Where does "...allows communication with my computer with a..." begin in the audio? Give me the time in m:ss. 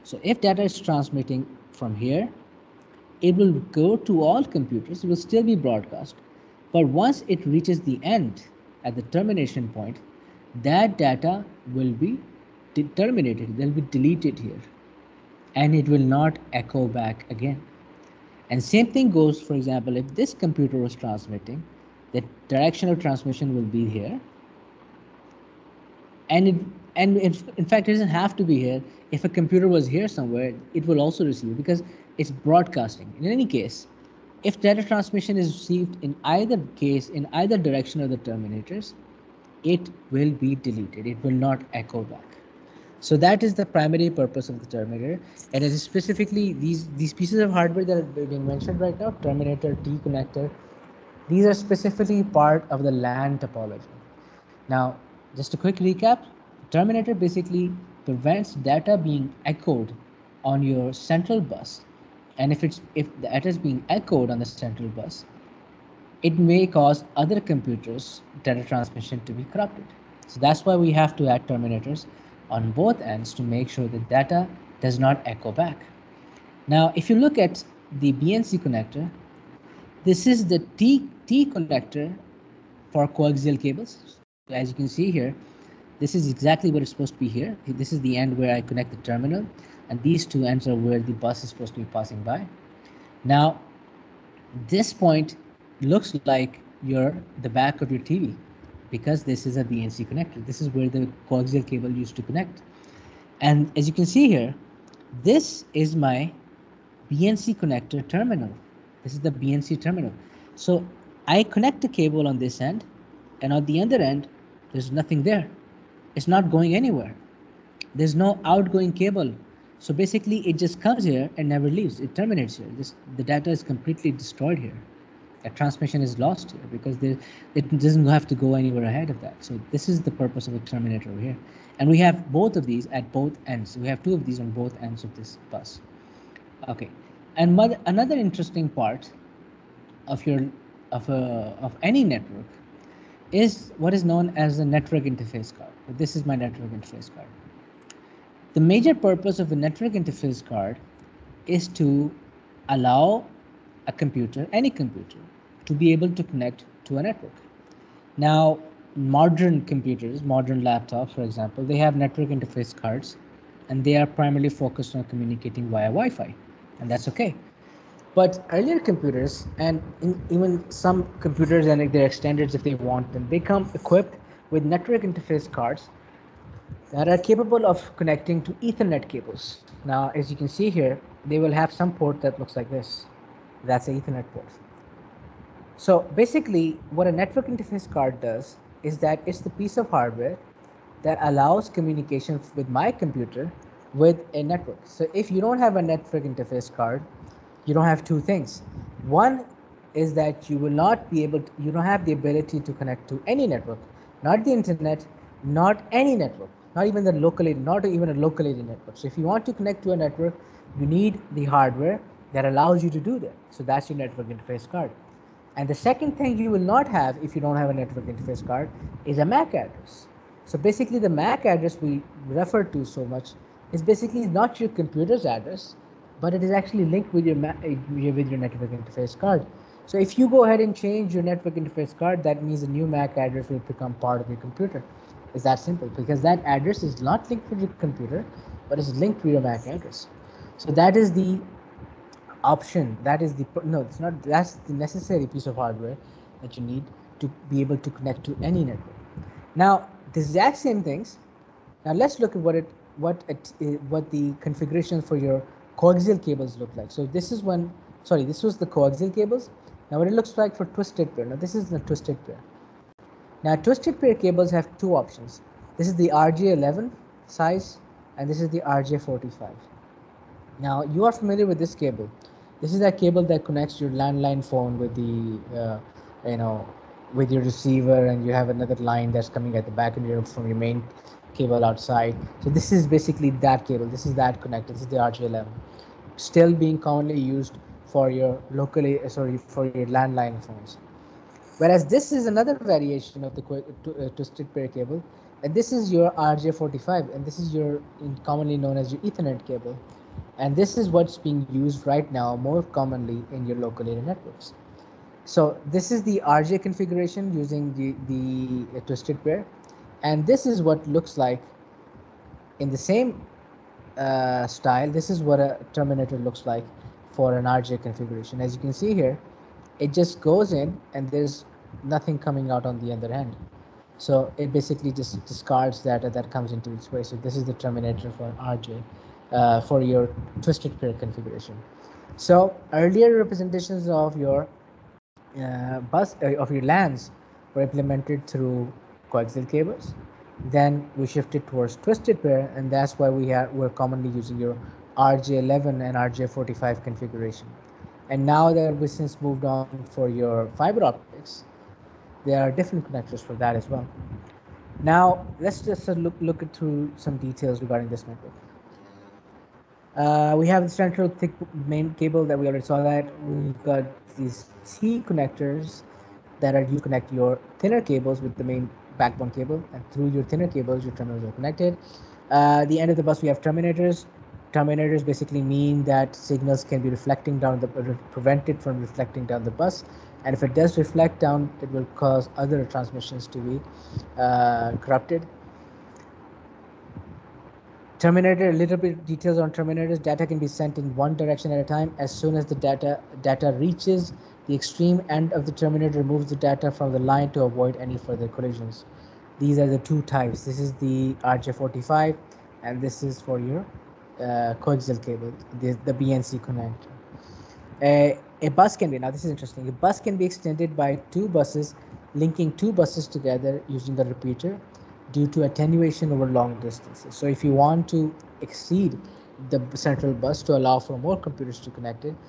3:11.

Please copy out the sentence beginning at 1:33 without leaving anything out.
Now, this point looks like your the back of your TV because this is a BNC connector.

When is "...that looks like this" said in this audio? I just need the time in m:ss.
3:02.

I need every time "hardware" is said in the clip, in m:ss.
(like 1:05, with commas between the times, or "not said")
0:47, 3:09, 3:31, 4:05.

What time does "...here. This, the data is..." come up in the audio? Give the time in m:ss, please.
2:02.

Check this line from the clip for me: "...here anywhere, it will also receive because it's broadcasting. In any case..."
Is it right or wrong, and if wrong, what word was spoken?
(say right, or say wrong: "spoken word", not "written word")
wrong: "somewhere", not "anywhere".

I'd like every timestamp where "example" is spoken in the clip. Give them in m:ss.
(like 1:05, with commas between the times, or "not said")
0:19, 2:41.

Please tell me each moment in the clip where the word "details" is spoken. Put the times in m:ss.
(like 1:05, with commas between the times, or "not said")
5:57, 6:29.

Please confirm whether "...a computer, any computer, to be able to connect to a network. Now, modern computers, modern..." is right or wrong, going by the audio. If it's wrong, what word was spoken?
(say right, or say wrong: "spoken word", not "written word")
right.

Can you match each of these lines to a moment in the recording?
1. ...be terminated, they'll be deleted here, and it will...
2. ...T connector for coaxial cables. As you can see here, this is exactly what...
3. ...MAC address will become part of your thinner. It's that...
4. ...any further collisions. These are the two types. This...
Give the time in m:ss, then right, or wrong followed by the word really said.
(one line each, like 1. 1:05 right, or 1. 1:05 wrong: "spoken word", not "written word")
1. 0:11 right
2. 1:21 right
3. 3:52 wrong: "computer", not "thinner"
4. 6:37 right.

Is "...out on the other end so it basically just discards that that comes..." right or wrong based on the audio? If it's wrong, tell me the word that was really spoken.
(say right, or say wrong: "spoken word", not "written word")
right.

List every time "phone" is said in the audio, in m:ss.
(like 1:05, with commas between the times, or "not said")
4:34, 4:50.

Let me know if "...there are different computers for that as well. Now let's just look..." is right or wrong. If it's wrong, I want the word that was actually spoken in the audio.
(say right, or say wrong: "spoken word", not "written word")
wrong: "connectors", not "computers".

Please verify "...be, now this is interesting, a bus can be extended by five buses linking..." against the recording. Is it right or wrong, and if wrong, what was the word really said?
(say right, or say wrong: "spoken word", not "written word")
wrong: "two", not "five".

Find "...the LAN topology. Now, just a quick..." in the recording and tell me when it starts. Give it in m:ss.
0:52.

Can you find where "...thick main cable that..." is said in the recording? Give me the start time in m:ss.
6:01.